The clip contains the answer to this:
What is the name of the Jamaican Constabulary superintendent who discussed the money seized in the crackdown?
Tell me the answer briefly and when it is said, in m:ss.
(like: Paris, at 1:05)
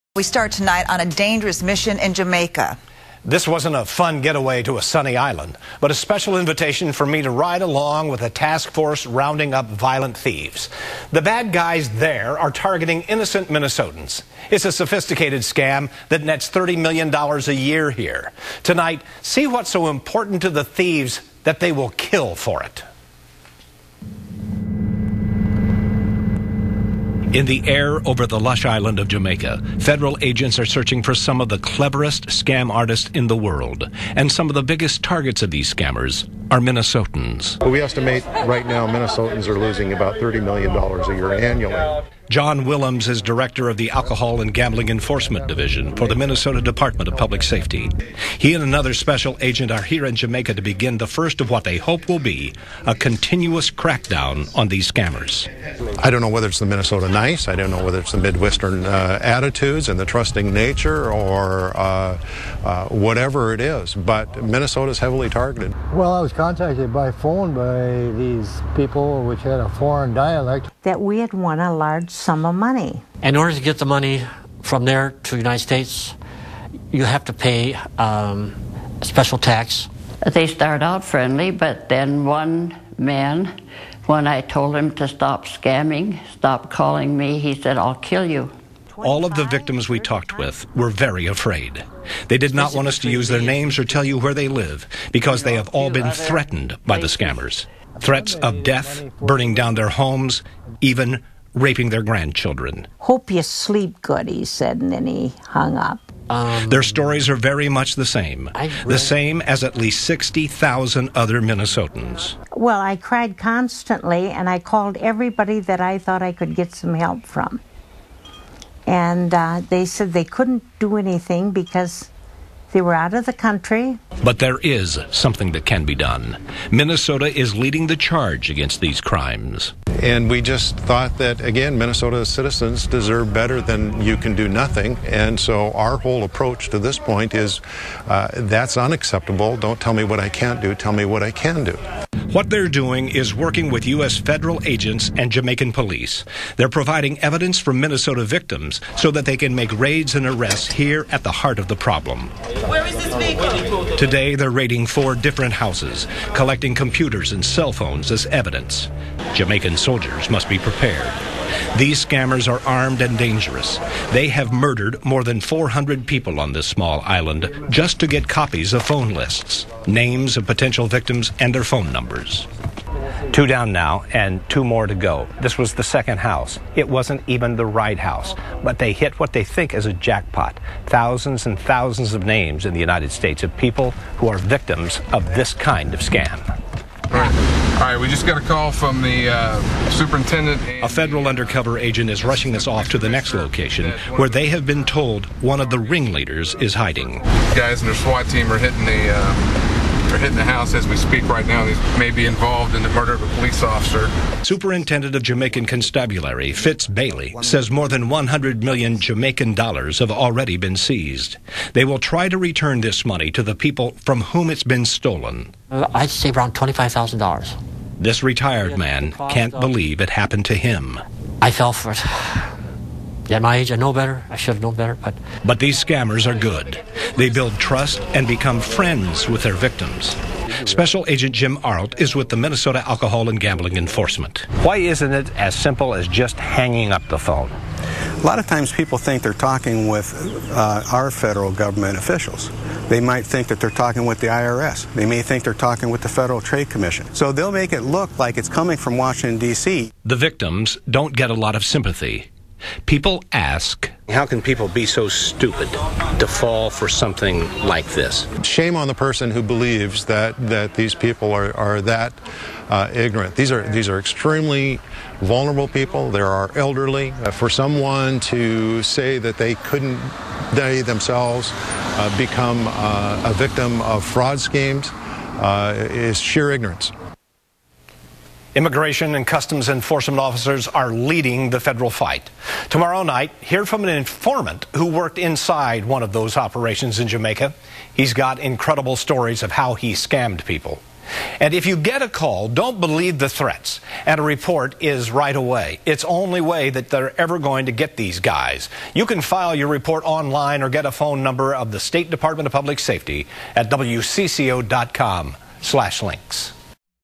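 Fitz Bailey, at 3:26.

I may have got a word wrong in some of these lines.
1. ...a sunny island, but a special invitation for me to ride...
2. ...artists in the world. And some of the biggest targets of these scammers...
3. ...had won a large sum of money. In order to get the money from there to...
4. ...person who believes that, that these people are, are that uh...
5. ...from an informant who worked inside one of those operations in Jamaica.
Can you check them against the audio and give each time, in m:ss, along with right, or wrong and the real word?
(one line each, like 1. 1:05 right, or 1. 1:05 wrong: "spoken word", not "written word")
1. 0:04 right
2. 0:32 right
3. 1:11 right
4. 4:18 right
5. 4:43 right.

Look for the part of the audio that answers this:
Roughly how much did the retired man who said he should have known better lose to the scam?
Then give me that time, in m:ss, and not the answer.
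3:36.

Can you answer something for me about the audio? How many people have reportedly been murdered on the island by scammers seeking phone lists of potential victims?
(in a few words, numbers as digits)
400.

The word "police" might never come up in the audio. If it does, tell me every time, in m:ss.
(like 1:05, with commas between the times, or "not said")
2:25, 3:23.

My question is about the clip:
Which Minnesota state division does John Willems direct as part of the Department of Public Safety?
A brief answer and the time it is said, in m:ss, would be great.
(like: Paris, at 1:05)
Alcohol and Gambling Enforcement Division, at 0:43.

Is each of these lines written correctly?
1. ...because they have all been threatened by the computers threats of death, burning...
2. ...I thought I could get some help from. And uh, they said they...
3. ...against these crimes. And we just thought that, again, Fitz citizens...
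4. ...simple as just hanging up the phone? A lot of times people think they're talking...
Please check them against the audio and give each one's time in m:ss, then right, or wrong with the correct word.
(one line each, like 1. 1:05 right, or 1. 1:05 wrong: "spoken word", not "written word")
1. 1:35 wrong: "scammers", not "computers"
2. 1:55 right
3. 2:08 wrong: "Minnesota", not "Fitz"
4. 3:55 right.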